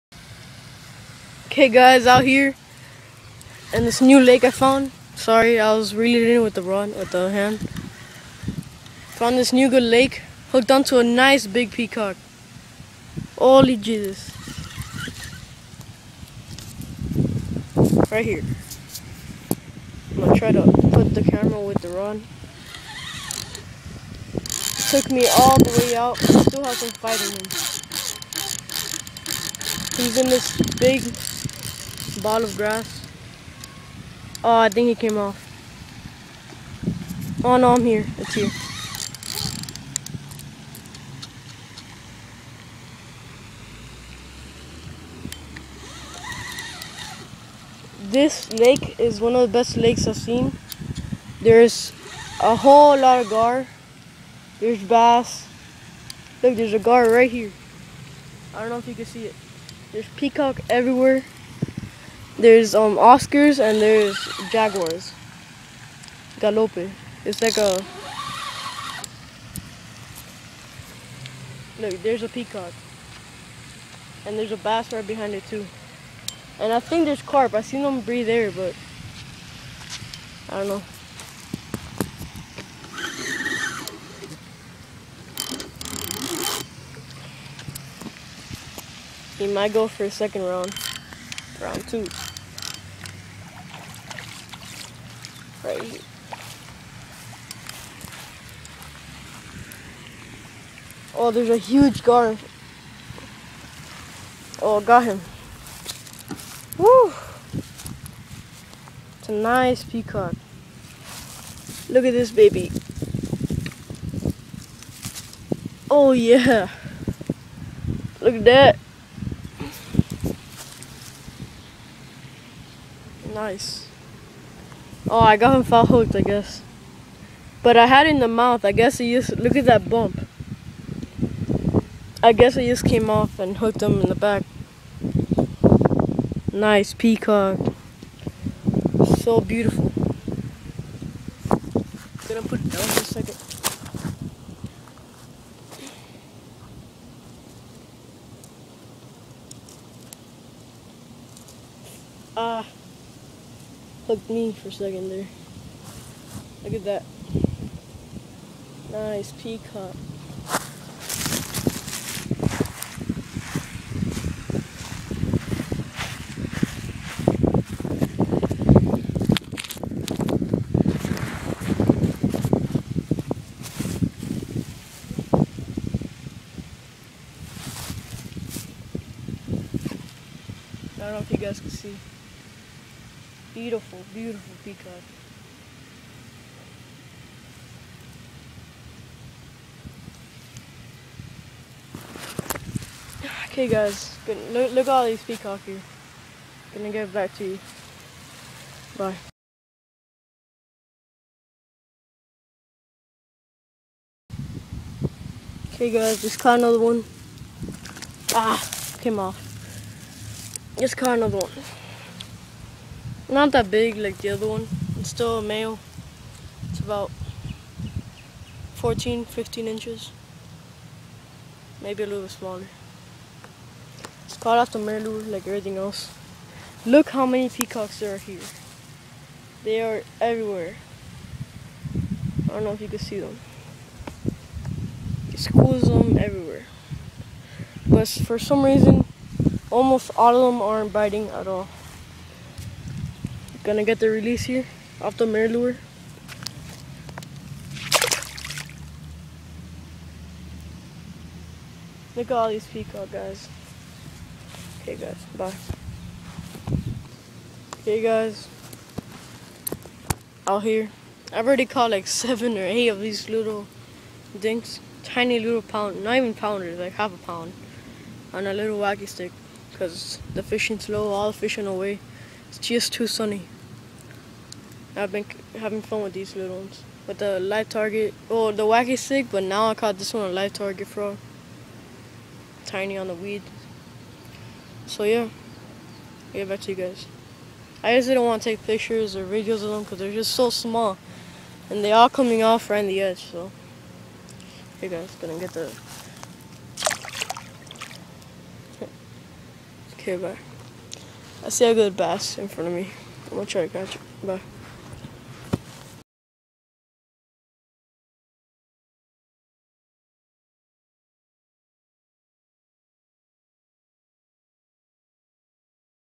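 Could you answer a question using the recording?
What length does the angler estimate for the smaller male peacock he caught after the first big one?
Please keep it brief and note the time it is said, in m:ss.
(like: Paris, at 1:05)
14-15 inches, at 3:38.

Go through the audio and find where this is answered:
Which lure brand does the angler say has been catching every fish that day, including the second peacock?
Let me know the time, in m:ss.
3:44.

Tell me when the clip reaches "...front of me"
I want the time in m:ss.
5:02.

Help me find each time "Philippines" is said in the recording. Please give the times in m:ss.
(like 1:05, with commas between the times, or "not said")
not said.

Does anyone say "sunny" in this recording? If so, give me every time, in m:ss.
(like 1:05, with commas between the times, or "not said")
4:33.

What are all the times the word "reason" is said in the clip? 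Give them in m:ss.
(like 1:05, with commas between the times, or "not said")
3:58.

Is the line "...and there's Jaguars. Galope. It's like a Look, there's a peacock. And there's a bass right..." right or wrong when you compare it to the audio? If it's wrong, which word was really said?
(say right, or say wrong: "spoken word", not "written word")
right.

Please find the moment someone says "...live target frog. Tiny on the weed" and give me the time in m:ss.
4:40.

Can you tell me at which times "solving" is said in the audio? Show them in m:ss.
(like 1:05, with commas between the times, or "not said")
not said.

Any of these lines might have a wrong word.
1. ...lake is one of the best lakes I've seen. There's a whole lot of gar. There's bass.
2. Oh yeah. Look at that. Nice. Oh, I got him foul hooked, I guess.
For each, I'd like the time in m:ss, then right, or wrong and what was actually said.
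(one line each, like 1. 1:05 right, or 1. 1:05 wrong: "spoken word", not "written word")
1. 0:48 right
2. 1:55 right.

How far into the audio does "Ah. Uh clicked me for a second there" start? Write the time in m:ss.
2:32.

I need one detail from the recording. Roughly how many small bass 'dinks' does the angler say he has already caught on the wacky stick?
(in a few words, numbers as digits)
7 or 8.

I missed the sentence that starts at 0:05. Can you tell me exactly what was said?
Sorry, I was reeling in with the rod, with the hand.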